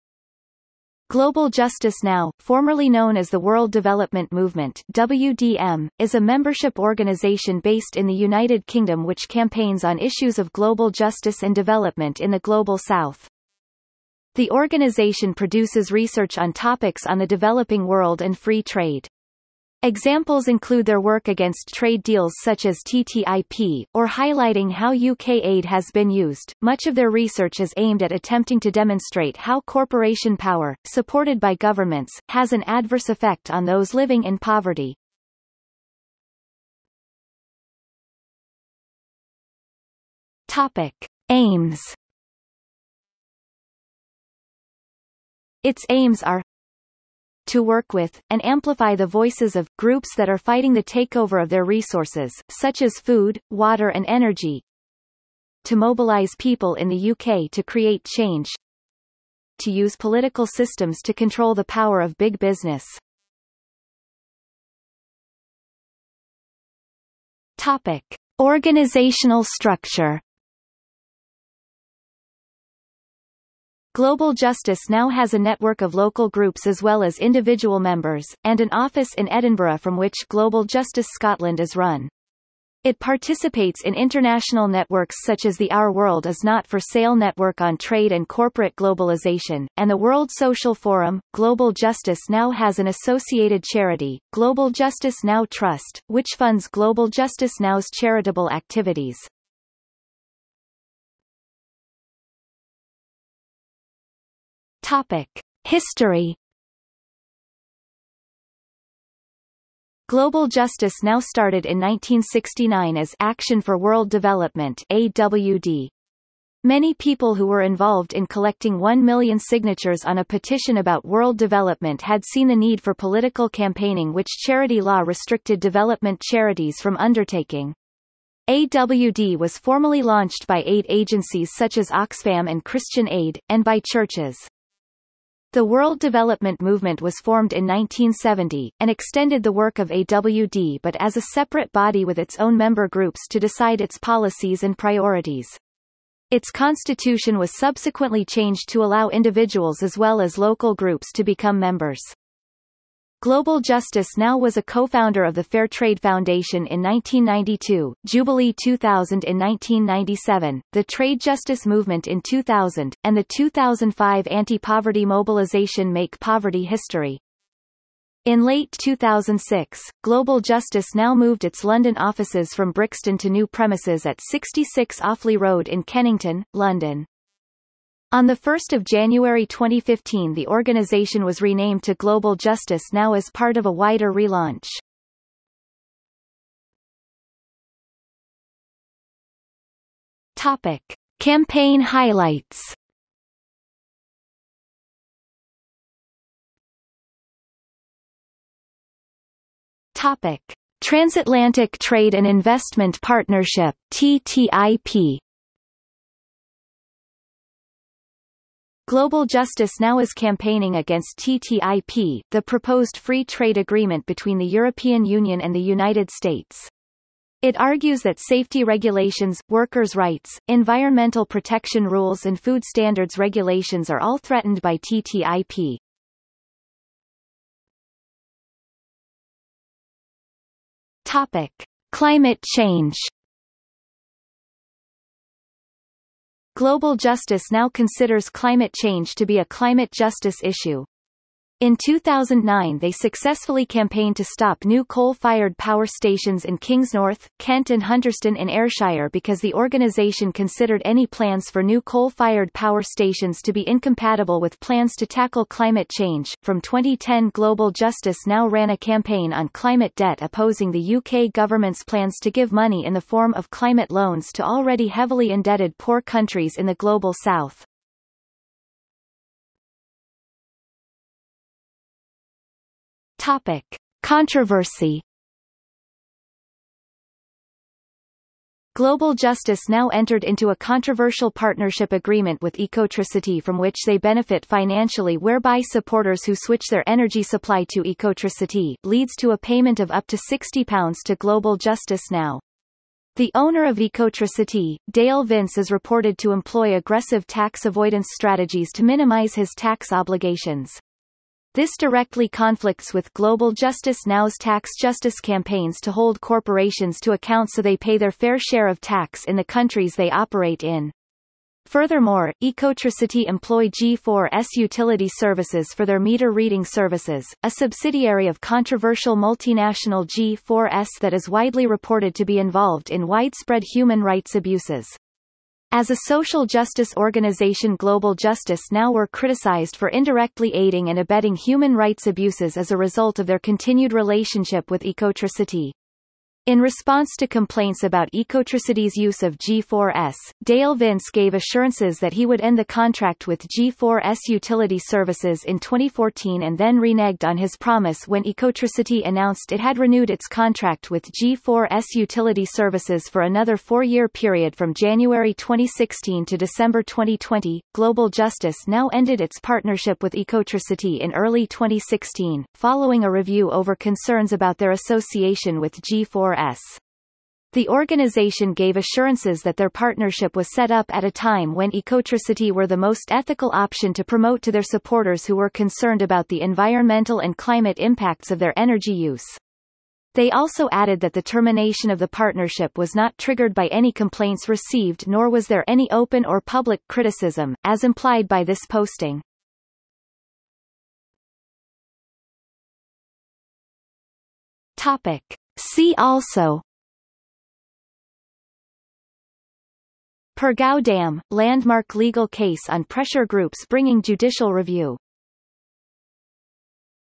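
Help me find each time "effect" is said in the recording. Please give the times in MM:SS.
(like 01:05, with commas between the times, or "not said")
00:33.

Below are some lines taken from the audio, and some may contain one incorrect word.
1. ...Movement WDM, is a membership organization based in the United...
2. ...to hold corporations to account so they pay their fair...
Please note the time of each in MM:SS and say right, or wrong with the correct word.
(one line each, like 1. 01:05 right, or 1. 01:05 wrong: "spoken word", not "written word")
1. 00:04 right
2. 05:05 right.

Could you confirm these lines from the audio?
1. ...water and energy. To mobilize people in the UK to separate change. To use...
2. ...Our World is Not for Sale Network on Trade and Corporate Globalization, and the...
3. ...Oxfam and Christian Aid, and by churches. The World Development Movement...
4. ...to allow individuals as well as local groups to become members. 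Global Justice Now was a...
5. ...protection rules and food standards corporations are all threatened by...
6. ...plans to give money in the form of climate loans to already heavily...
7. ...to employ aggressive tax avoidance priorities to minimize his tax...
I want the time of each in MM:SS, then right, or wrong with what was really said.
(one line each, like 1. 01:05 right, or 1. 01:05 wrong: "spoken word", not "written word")
1. 00:53 wrong: "create", not "separate"
2. 01:25 right
3. 02:11 right
4. 02:28 right
5. 03:41 wrong: "regulations", not "corporations"
6. 04:21 right
7. 04:56 wrong: "strategies", not "priorities".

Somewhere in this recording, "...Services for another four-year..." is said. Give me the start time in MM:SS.
05:52.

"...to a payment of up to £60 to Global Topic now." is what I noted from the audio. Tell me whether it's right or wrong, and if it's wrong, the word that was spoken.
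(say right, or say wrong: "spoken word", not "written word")
wrong: "Justice", not "Topic".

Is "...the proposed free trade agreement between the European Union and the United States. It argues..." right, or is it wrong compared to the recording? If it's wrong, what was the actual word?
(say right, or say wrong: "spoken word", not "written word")
right.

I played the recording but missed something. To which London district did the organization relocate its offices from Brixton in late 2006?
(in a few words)
Kennington.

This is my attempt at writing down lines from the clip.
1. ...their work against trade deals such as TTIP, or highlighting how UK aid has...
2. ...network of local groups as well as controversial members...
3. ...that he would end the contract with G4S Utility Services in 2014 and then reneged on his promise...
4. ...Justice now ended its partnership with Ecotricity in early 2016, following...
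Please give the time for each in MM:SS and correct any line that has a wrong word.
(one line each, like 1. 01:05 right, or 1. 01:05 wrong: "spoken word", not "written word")
1. 00:20 right
2. 01:15 wrong: "individual", not "controversial"
3. 05:41 right
4. 05:58 right.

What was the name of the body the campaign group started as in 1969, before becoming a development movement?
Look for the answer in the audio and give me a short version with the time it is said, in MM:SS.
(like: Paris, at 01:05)
Action for World Development, at 01:53.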